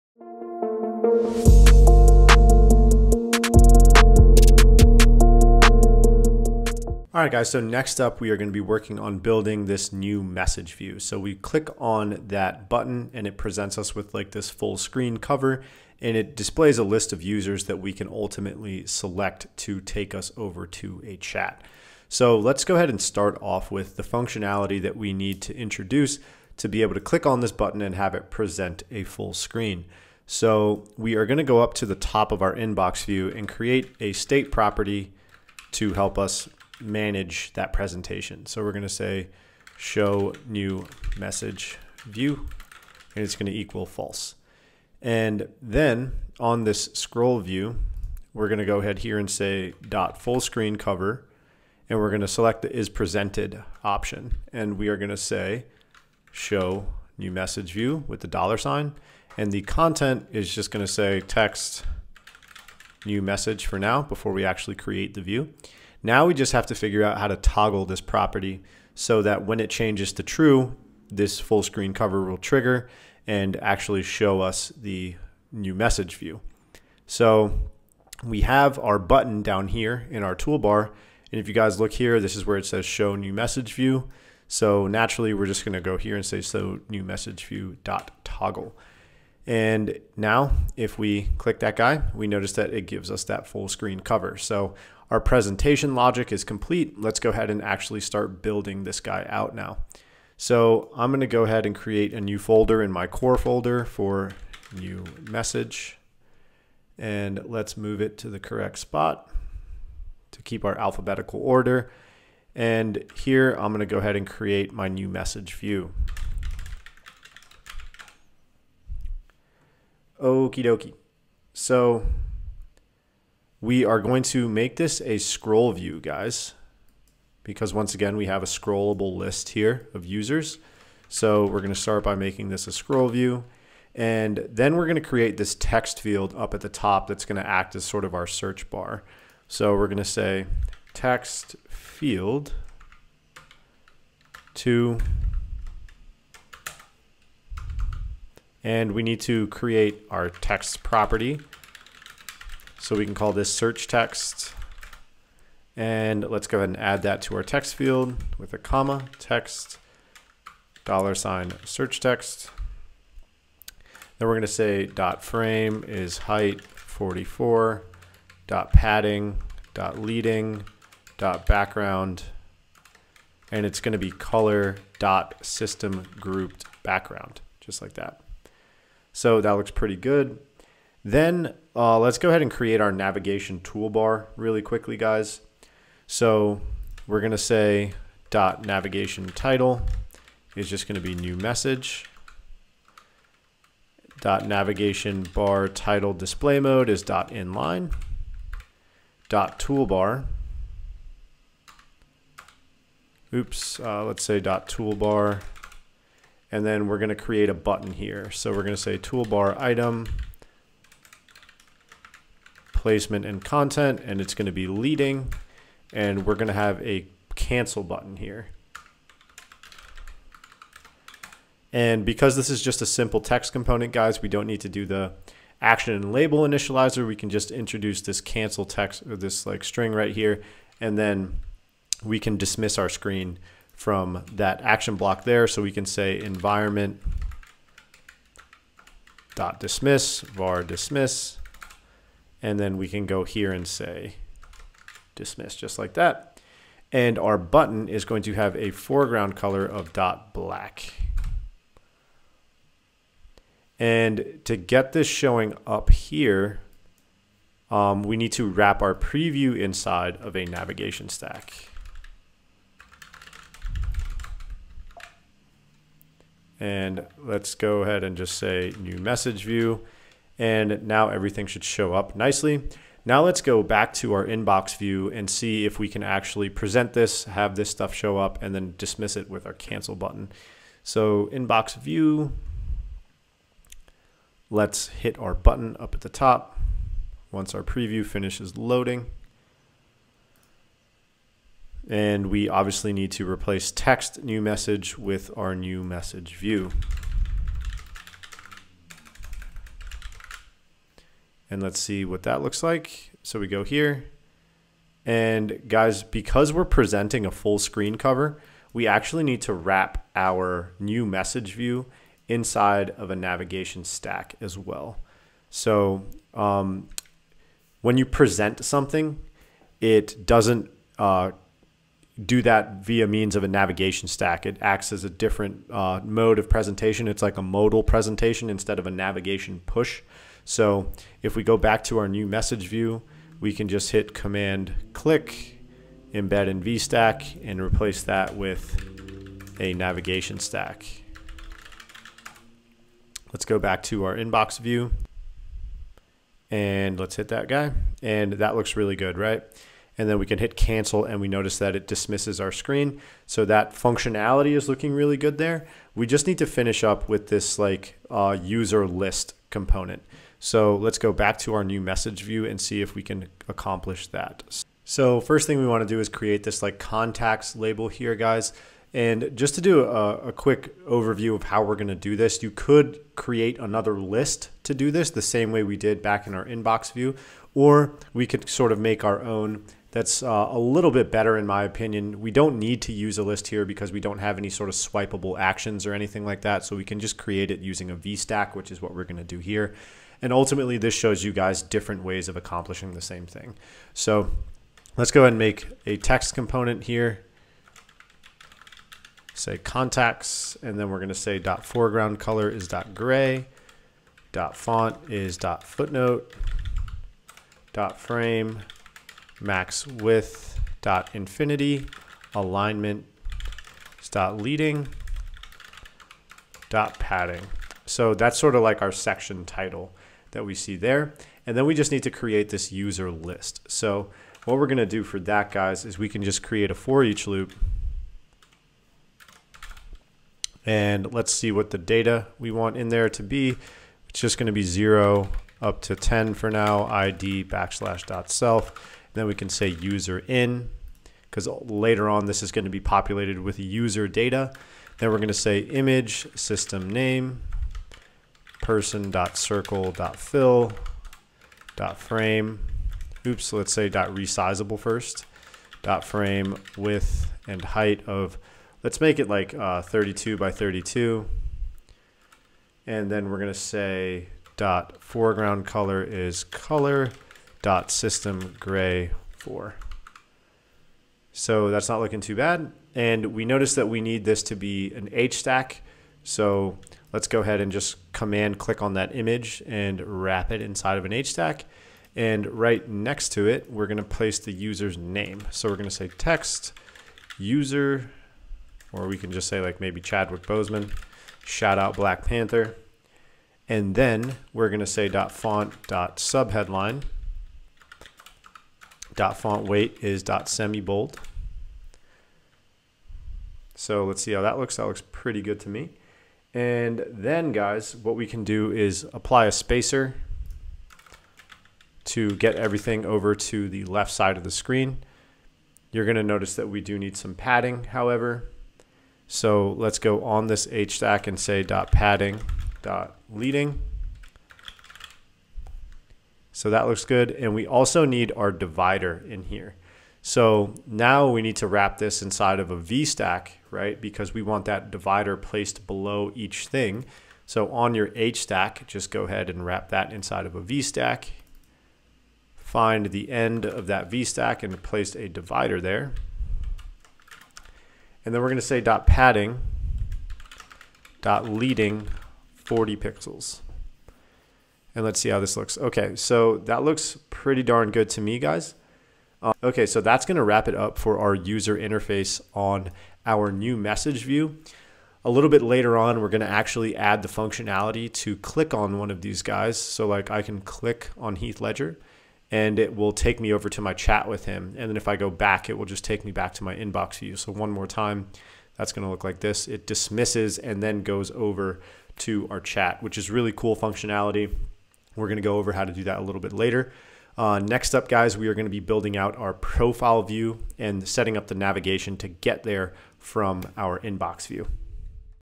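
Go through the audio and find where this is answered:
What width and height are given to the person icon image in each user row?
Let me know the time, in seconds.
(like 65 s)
459 s.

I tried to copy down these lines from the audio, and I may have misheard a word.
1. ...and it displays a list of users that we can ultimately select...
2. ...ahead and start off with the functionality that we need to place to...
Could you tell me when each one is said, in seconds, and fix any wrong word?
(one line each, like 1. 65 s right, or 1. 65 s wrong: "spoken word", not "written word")
1. 15 s right
2. 22 s wrong: "introduce", not "place".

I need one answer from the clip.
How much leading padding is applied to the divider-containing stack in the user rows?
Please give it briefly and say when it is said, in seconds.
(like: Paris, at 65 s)
40 pixels, at 552 s.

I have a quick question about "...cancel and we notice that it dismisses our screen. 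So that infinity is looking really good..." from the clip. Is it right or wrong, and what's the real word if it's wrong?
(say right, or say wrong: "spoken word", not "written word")
wrong: "functionality", not "infinity".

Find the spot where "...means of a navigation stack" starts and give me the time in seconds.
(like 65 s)
323 s.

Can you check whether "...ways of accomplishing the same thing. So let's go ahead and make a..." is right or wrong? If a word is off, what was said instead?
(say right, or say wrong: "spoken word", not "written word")
right.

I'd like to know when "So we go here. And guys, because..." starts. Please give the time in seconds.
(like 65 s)
303 s.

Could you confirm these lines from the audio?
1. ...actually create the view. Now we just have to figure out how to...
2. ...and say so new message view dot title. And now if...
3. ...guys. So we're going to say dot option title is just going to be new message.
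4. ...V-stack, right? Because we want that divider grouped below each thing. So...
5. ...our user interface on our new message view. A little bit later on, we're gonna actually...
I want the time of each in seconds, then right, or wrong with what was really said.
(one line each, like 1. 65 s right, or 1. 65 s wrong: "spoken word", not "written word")
1. 64 s right
2. 86 s wrong: "toggle", not "title"
3. 184 s wrong: "navigation", not "option"
4. 532 s wrong: "placed", not "grouped"
5. 561 s right.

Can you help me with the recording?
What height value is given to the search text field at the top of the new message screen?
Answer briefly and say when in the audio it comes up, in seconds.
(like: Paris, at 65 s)
44, at 166 s.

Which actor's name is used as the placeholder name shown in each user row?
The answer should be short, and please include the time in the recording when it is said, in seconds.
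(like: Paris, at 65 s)
Chadwick Bozeman, at 490 s.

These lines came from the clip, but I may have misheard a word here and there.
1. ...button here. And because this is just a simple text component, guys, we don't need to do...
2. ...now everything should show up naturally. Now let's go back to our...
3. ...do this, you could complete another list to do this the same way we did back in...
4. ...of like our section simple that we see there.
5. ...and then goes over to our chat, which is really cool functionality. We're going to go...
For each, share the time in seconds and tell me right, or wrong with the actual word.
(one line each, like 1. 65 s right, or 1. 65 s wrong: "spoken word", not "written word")
1. 217 s right
2. 270 s wrong: "nicely", not "naturally"
3. 371 s wrong: "create", not "complete"
4. 418 s wrong: "title", not "simple"
5. 580 s right.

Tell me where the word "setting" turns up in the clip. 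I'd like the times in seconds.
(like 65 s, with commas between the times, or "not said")
591 s.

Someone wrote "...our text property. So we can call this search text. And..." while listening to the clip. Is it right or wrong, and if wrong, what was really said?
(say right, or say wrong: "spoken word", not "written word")
right.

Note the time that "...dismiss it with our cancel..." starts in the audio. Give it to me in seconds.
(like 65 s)
278 s.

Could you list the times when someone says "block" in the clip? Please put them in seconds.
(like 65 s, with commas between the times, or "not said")
234 s.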